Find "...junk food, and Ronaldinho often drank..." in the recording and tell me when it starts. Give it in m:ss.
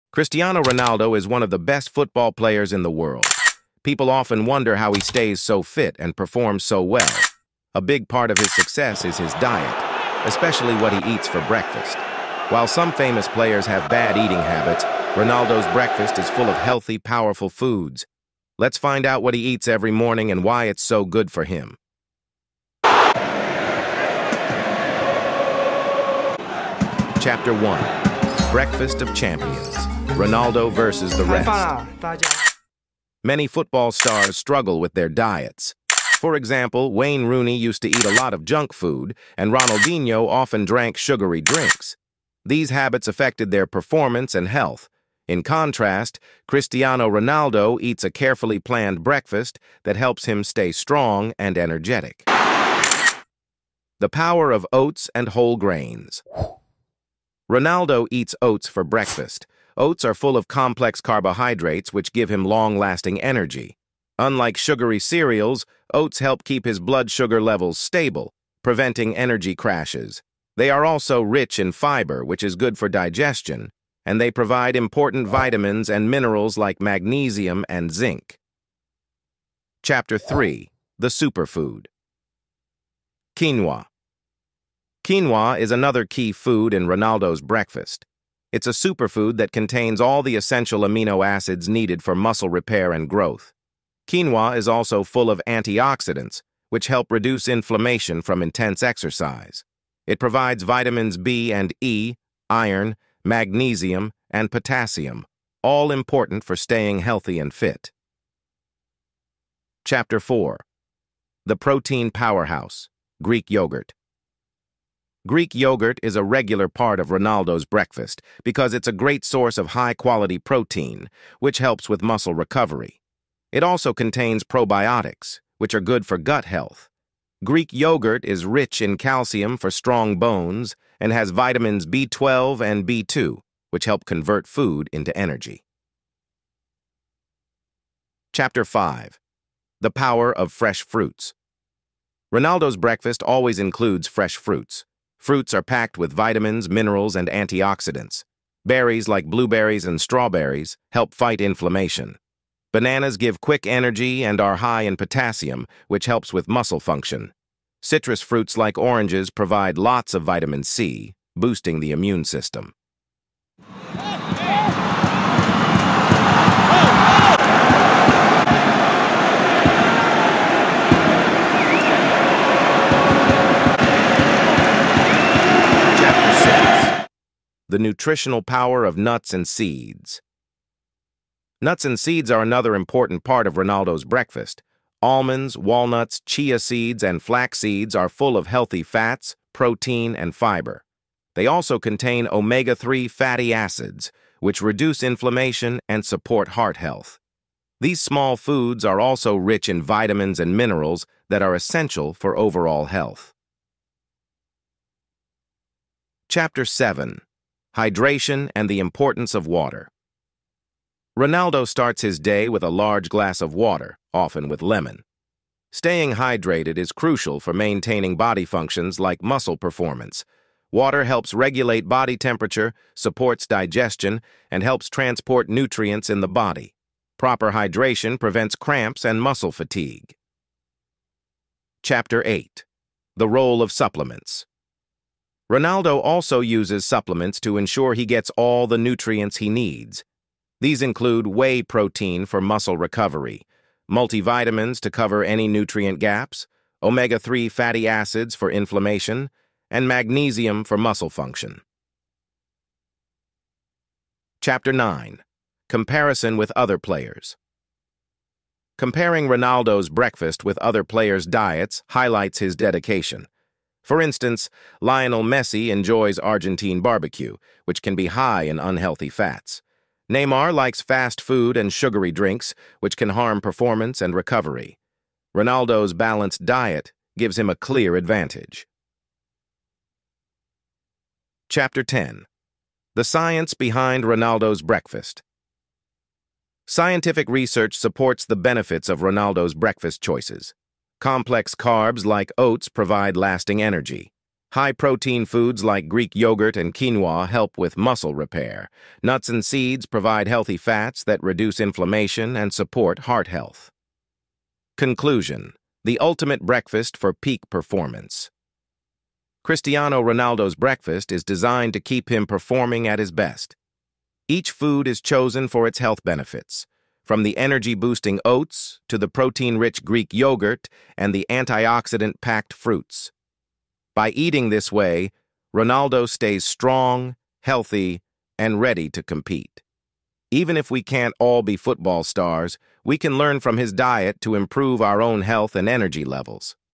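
0:38.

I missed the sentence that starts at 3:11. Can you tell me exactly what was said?
They also contain omega-3 fatty acids, which reduce inflammation and support heart health.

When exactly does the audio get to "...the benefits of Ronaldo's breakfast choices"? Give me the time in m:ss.
4:48.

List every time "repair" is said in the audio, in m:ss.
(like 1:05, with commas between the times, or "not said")
1:32, 4:58.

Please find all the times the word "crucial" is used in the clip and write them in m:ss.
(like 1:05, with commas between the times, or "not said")
3:36.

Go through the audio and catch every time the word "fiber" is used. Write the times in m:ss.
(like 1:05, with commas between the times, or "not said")
1:11, 3:10.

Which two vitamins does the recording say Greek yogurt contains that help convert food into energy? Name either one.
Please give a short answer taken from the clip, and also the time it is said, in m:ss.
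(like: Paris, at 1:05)
B12 and B2, at 2:11.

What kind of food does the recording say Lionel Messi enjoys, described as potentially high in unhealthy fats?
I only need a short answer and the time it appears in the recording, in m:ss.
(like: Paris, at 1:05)
Argentine barbecue, at 4:26.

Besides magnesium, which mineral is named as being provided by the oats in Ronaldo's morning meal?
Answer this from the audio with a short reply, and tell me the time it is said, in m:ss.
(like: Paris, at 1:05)
Zinc, at 1:17.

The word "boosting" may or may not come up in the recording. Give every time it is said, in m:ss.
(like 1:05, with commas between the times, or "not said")
2:41, 5:17.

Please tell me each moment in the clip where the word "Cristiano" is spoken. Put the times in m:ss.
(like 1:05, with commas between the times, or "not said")
0:00, 0:46, 5:09.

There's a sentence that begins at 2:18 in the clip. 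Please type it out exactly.
Chapter 5 The Power of Fresh Fruits Ronaldo's breakfast always includes fresh fruits, Fruits are packed with vitamins, minerals, and antioxidants.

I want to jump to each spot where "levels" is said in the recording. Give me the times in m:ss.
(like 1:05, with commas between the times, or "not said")
1:07, 5:36.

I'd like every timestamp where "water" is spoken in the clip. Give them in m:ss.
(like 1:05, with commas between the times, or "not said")
3:29, 3:33, 3:40.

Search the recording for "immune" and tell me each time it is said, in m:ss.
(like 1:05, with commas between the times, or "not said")
2:41.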